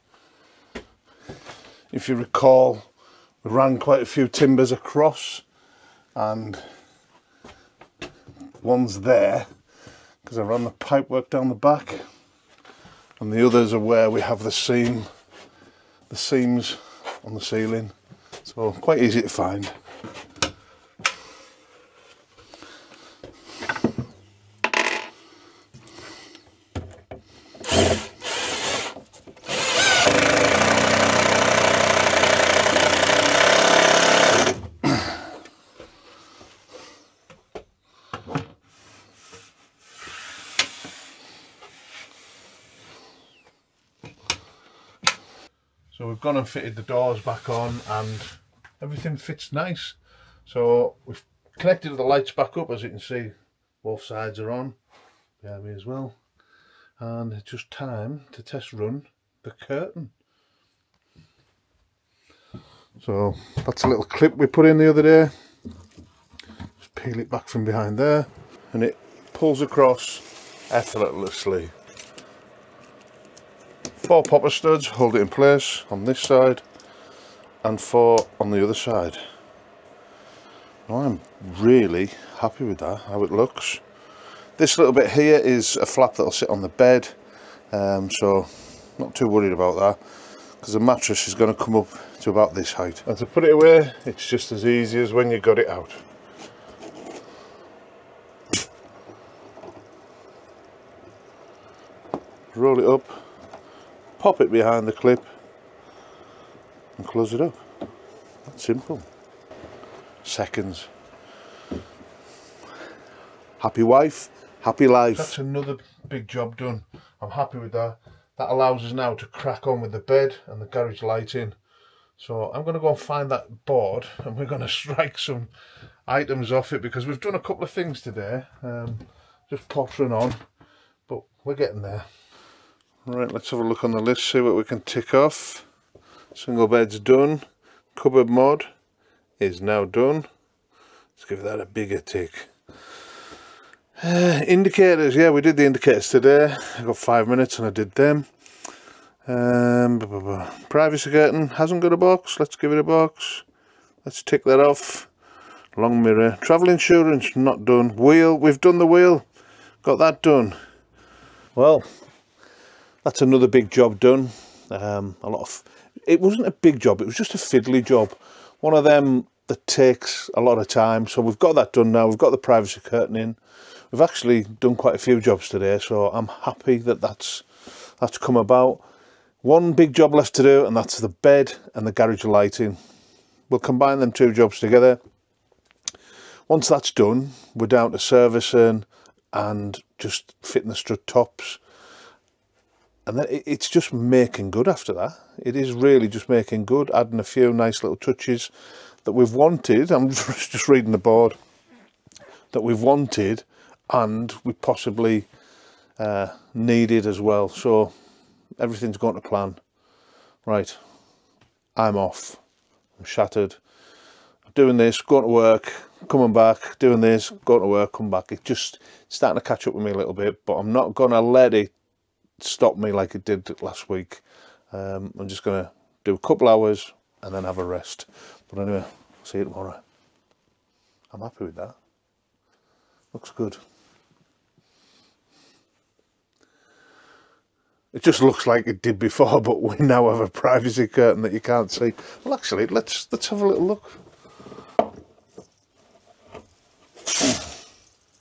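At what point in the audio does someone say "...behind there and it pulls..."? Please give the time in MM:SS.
01:07.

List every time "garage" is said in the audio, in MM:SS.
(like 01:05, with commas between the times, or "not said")
02:00, 03:01.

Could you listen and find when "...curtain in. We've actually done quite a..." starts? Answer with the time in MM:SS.
02:52.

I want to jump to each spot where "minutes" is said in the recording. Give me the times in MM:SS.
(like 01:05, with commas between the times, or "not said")
02:27.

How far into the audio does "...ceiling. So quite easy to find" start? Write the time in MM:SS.
00:17.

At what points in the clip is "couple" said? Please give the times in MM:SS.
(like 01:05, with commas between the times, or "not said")
02:07, 03:46.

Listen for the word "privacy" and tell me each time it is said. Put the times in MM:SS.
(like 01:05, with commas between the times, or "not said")
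02:30, 02:52, 04:00.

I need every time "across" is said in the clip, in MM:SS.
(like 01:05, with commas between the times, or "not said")
00:04, 01:09.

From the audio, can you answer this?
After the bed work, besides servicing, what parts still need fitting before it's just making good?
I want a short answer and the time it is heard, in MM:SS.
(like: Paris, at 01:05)
Strut tops, at 03:10.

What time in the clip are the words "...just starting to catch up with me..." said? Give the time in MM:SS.
03:38.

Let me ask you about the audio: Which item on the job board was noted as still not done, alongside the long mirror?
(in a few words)
Travel insurance.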